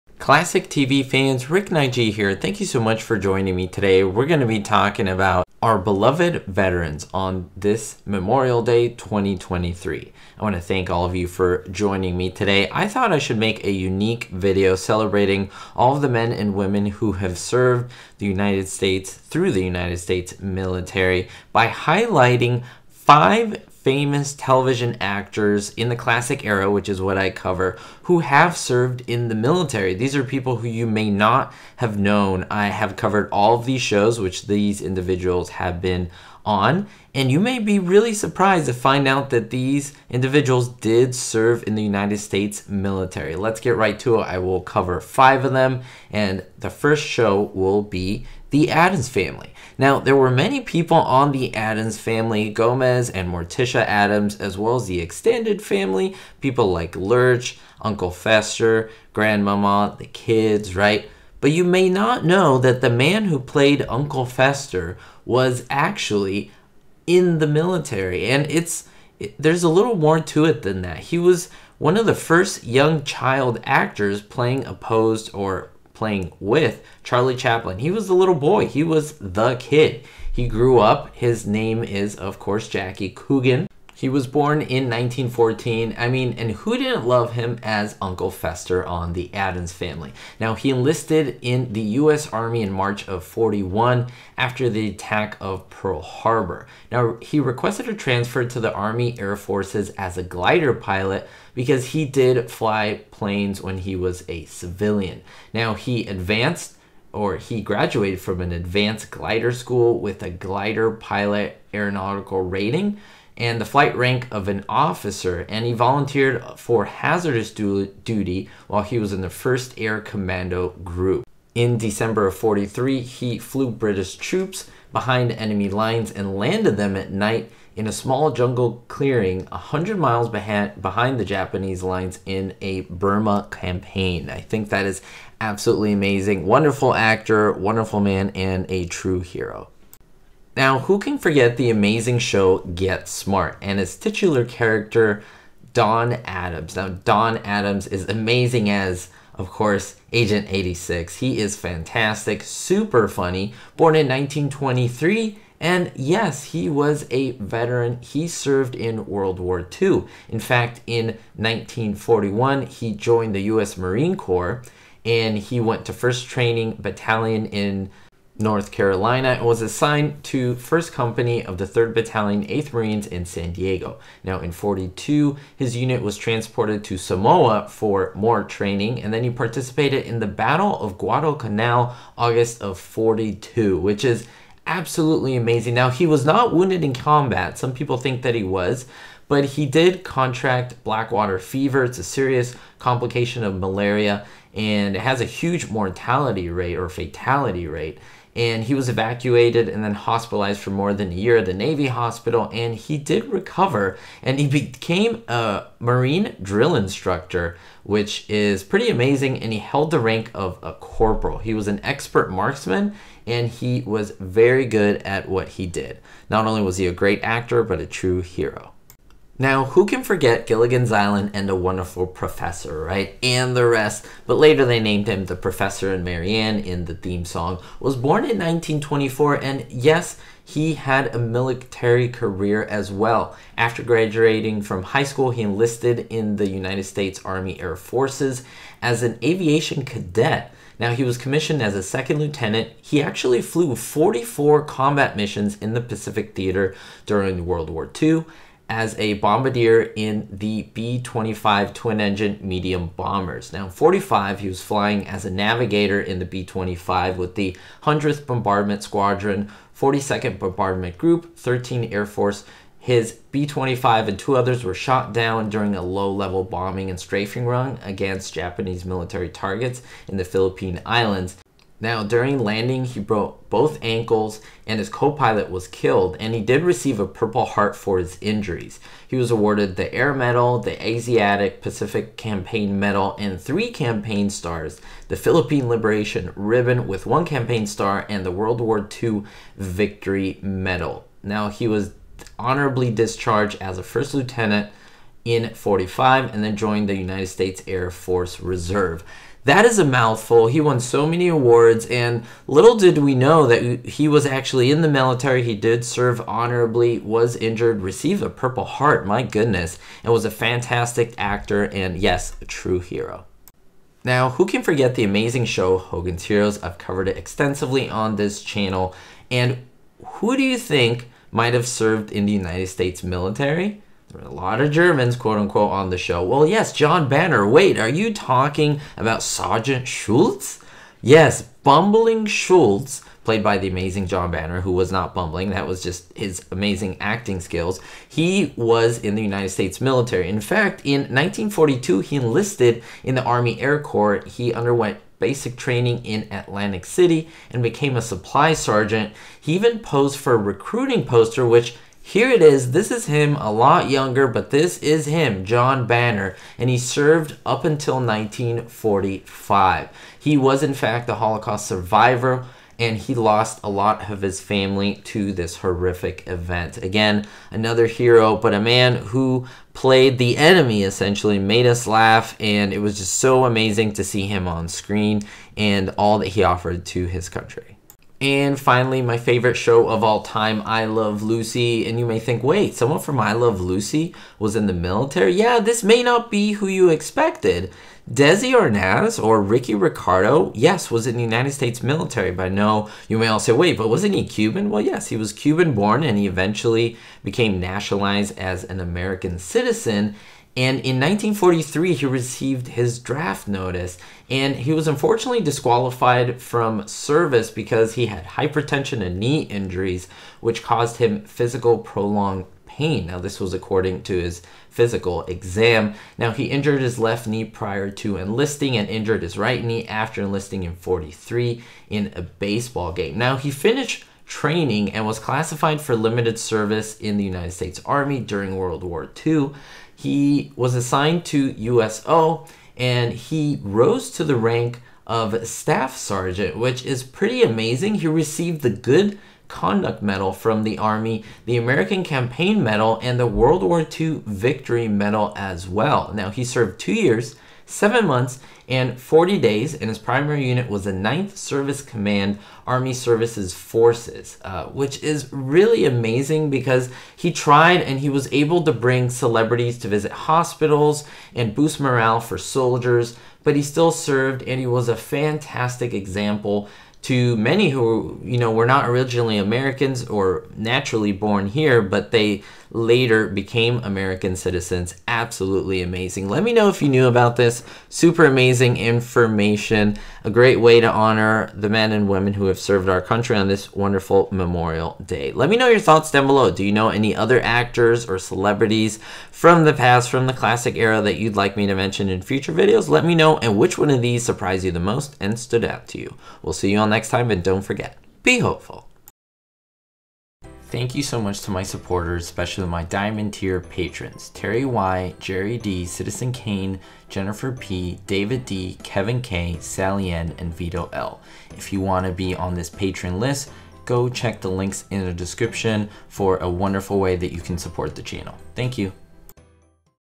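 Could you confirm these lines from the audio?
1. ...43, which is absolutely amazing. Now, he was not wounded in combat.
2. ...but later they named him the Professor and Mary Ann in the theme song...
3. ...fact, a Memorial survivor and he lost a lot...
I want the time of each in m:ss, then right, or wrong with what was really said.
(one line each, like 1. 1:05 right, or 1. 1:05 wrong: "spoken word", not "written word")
1. 3:02 wrong: "42", not "43"
2. 3:44 right
3. 6:00 wrong: "Holocaust", not "Memorial".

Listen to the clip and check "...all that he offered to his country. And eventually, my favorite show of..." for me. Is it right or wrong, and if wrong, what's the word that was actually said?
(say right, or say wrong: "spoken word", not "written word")
wrong: "finally", not "eventually".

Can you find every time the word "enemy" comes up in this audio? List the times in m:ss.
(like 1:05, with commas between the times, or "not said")
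2:05, 6:10.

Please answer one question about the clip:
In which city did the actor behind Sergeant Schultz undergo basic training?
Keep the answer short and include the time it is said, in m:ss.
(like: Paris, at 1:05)
Atlantic City, at 5:46.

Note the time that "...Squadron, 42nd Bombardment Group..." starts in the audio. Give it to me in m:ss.
4:18.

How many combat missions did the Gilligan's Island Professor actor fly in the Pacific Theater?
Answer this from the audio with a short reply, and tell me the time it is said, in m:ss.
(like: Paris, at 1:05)
44, at 4:03.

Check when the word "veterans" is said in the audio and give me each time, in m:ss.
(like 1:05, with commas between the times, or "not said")
0:06, 2:37.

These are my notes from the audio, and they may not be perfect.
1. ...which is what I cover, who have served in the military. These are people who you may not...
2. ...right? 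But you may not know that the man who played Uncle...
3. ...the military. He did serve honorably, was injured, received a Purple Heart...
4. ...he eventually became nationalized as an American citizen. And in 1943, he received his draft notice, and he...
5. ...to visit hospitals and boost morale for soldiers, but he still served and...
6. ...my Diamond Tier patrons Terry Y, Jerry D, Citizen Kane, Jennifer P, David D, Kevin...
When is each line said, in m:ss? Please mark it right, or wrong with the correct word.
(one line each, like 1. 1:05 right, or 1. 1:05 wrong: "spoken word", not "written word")
1. 0:26 right
2. 1:00 right
3. 5:04 right
4. 6:36 right
5. 7:39 right
6. 8:22 right.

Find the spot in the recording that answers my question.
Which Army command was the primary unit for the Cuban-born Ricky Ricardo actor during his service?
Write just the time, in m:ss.
7:30.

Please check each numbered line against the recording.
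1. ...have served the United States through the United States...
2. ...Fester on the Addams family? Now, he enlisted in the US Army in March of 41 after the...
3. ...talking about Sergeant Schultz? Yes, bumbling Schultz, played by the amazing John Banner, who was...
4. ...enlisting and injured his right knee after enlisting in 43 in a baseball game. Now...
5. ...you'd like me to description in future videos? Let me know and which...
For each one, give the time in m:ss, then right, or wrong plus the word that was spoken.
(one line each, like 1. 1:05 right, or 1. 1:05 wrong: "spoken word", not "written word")
1. 0:17 right
2. 1:28 right
3. 5:28 right
4. 6:58 right
5. 8:11 wrong: "mention", not "description".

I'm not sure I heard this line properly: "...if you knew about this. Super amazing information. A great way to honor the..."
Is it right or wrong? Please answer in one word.
right.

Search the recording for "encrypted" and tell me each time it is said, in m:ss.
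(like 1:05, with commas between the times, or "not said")
not said.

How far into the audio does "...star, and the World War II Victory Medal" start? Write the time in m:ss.
4:47.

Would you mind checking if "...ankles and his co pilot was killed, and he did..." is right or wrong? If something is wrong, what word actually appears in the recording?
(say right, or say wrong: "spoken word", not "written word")
right.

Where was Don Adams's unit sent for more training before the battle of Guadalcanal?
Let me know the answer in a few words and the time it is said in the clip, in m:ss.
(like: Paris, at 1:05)
Samoa, at 2:56.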